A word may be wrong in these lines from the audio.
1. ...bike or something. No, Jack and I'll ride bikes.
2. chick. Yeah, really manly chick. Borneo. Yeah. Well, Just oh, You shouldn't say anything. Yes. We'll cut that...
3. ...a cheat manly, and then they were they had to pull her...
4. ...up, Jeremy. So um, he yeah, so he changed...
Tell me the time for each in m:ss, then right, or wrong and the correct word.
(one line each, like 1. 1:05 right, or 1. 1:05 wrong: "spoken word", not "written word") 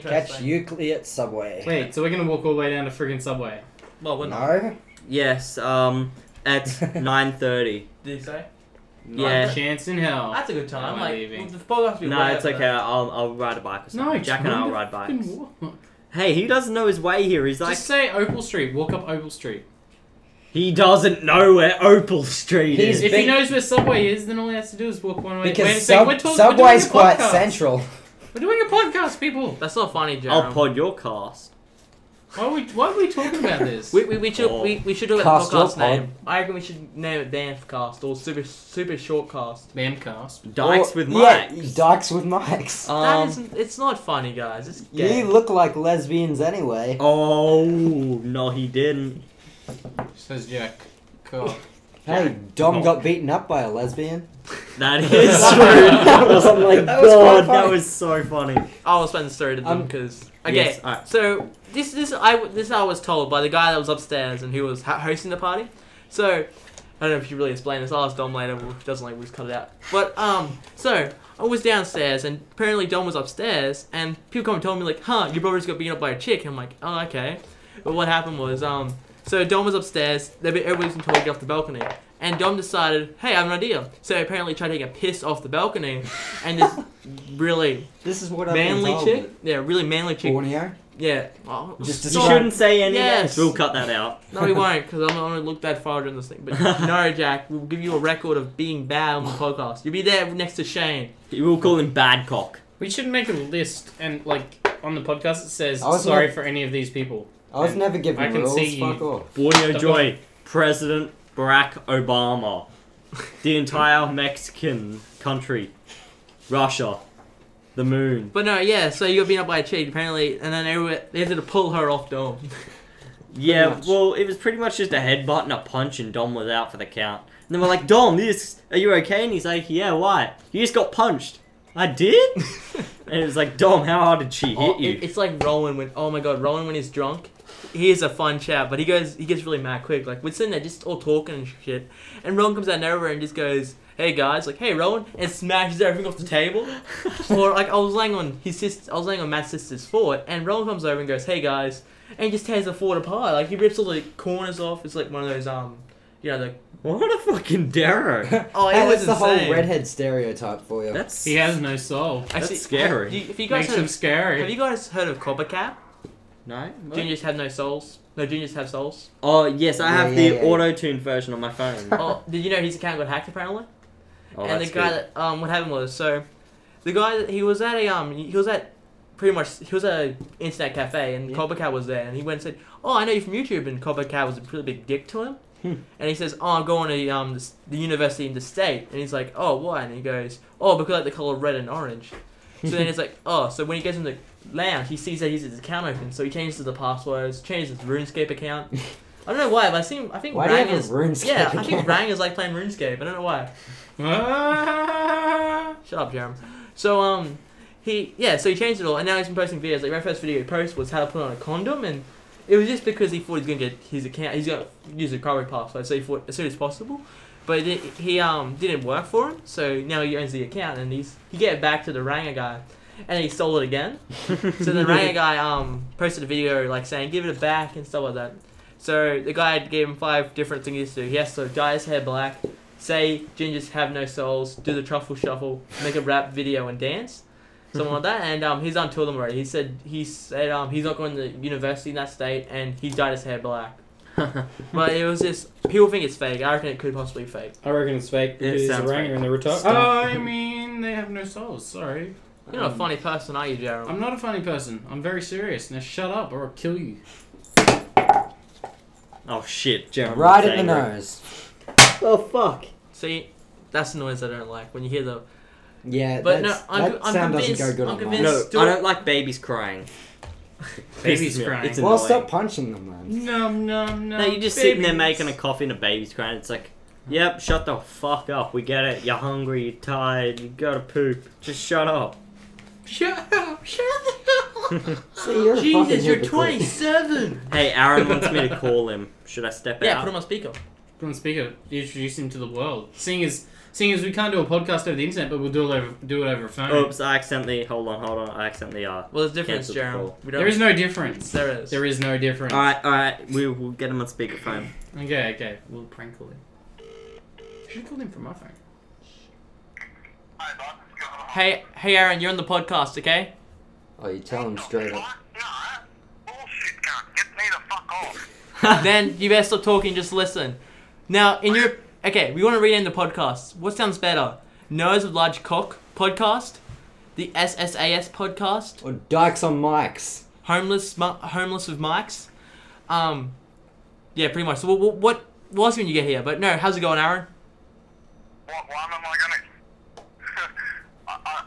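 1. 0:13 right
2. 1:29 right
3. 1:59 wrong: "apparently", not "manly"
4. 3:25 right.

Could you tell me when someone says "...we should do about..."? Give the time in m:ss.
0:34.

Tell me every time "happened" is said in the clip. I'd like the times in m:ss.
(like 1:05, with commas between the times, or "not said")
1:18, 2:55.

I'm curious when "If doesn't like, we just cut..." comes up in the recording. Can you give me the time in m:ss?
1:08.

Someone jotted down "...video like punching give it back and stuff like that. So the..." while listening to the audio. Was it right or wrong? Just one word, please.
wrong.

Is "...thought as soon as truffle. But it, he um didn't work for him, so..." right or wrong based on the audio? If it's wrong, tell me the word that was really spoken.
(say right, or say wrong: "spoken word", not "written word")
wrong: "possible", not "truffle".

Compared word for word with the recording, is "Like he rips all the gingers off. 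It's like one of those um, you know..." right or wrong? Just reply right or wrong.
wrong.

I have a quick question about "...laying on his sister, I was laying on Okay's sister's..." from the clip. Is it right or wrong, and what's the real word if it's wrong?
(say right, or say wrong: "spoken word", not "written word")
wrong: "Matt", not "Okay".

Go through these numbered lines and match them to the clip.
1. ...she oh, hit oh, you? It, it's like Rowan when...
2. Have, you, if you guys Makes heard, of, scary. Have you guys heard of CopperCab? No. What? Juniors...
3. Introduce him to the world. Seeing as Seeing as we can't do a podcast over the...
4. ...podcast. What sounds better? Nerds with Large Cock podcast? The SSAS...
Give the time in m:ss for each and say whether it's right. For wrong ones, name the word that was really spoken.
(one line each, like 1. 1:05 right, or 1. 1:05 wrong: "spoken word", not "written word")
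1. 2:14 right
2. 2:43 right
3. 4:51 right
4. 5:22 right.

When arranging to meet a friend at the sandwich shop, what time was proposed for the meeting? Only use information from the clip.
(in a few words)
9:30.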